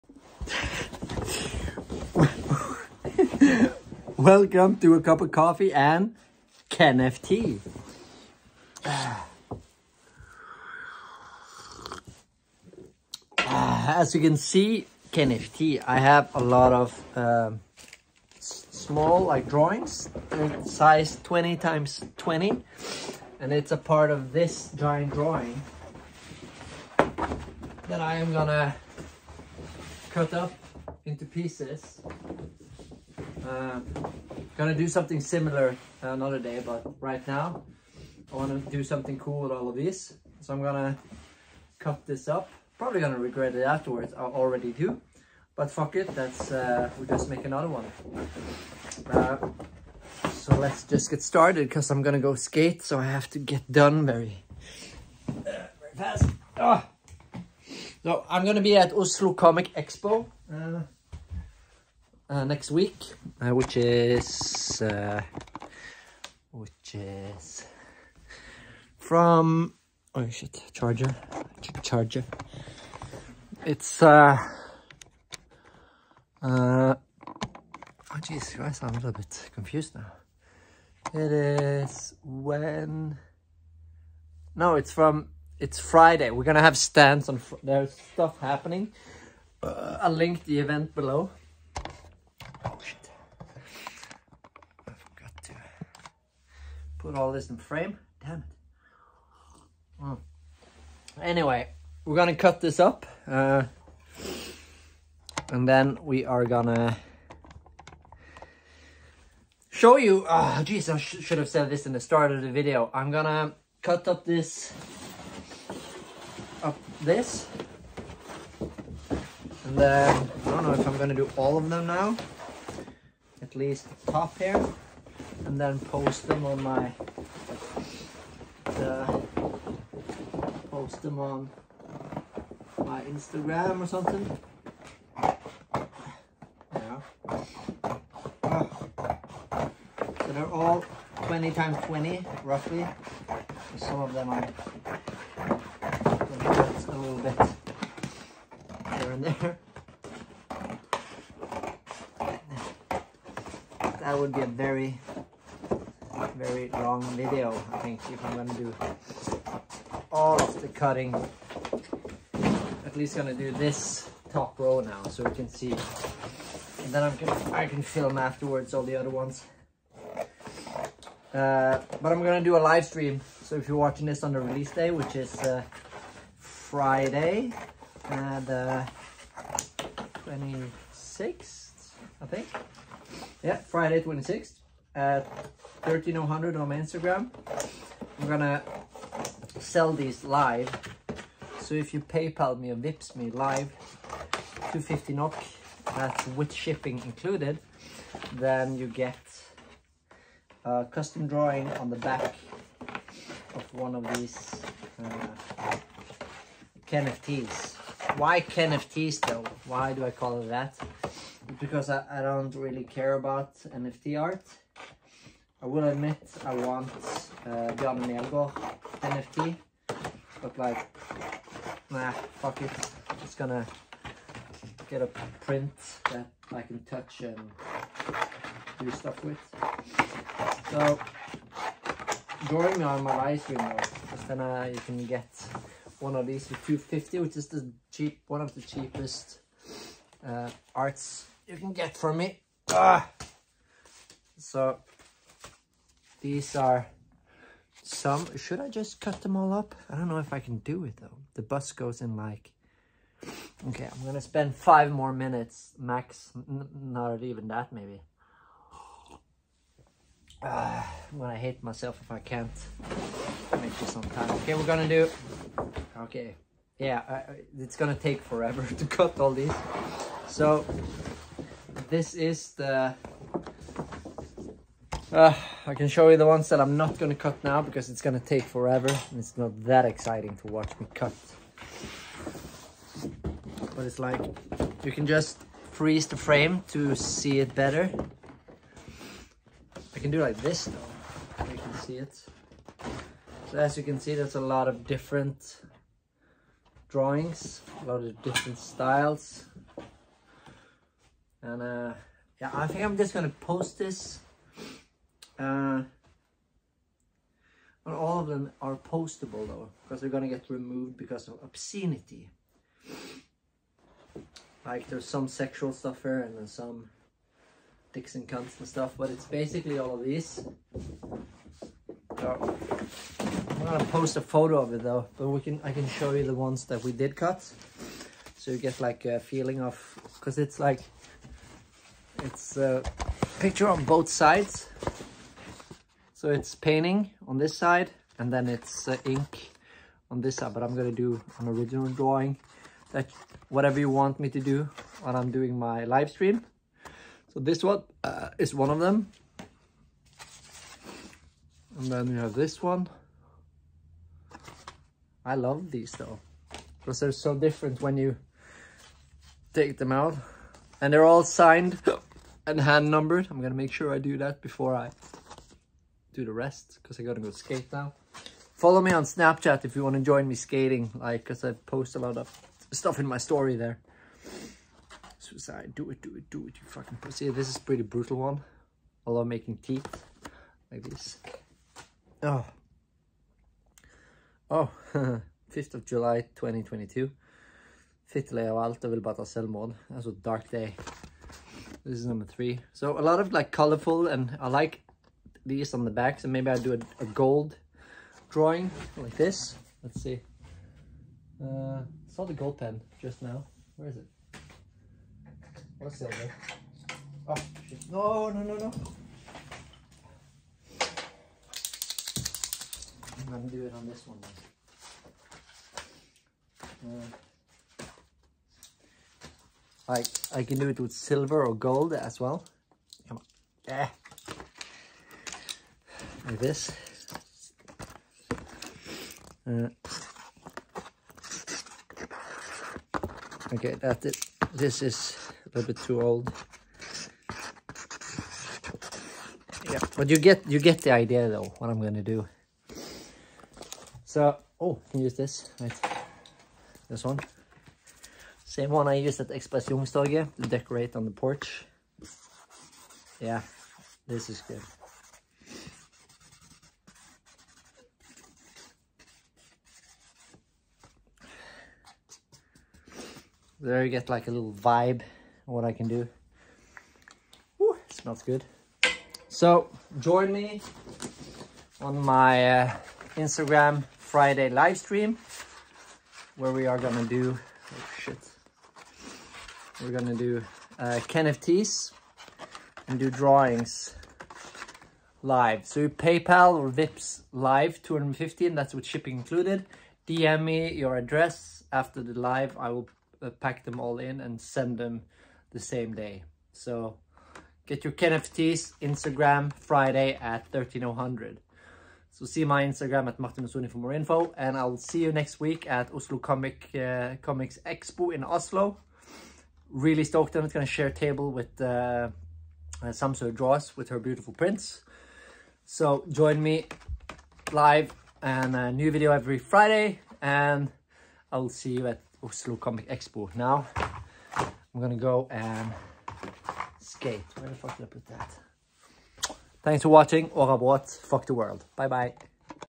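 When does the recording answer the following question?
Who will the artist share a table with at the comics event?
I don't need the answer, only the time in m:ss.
8:32.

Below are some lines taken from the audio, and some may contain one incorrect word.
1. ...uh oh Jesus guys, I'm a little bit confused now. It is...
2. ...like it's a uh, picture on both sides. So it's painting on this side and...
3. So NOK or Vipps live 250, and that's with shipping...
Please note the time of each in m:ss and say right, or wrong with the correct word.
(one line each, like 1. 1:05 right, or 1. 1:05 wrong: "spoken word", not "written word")
1. 1:16 right
2. 5:30 right
3. 8:05 wrong: "PayPal", not "NOK".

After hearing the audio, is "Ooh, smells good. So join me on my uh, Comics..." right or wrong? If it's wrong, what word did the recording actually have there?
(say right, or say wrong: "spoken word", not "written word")
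wrong: "Instagram", not "Comics".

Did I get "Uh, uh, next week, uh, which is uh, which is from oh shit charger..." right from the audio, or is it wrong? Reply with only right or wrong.
right.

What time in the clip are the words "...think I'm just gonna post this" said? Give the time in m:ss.
5:02.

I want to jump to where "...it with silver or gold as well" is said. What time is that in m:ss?
7:00.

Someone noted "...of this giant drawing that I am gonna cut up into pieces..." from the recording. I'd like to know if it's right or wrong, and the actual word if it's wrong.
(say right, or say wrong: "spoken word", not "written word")
right.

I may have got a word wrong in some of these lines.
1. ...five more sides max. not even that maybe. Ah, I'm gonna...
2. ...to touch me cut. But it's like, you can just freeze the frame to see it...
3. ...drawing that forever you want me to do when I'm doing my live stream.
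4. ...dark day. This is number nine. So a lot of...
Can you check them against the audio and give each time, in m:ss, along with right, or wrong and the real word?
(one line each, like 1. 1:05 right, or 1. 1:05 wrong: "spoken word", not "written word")
1. 4:14 wrong: "minutes", not "sides"
2. 4:40 wrong: "watch", not "touch"
3. 5:41 wrong: "whatever", not "forever"
4. 6:30 wrong: "three", not "nine".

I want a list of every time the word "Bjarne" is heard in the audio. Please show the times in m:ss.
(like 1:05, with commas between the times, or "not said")
3:37.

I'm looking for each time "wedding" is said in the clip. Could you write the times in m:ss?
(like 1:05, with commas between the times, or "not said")
not said.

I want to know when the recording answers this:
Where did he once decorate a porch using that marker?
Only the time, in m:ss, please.
7:29.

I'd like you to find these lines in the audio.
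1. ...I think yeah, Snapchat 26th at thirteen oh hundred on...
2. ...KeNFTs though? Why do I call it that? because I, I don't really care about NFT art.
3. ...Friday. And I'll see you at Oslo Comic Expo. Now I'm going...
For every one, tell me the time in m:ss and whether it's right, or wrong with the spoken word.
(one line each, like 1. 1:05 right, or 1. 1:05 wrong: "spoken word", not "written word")
1. 3:02 wrong: "Friday", not "Snapchat"
2. 3:28 right
3. 8:39 right.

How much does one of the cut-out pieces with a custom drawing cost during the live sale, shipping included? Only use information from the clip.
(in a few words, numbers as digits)
250 NOK.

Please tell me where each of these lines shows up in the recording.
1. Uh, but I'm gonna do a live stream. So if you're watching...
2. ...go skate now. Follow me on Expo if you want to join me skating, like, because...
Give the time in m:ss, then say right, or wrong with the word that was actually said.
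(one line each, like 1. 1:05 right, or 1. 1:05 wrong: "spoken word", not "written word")
1. 2:51 right
2. 6:07 wrong: "Snapchat", not "Expo".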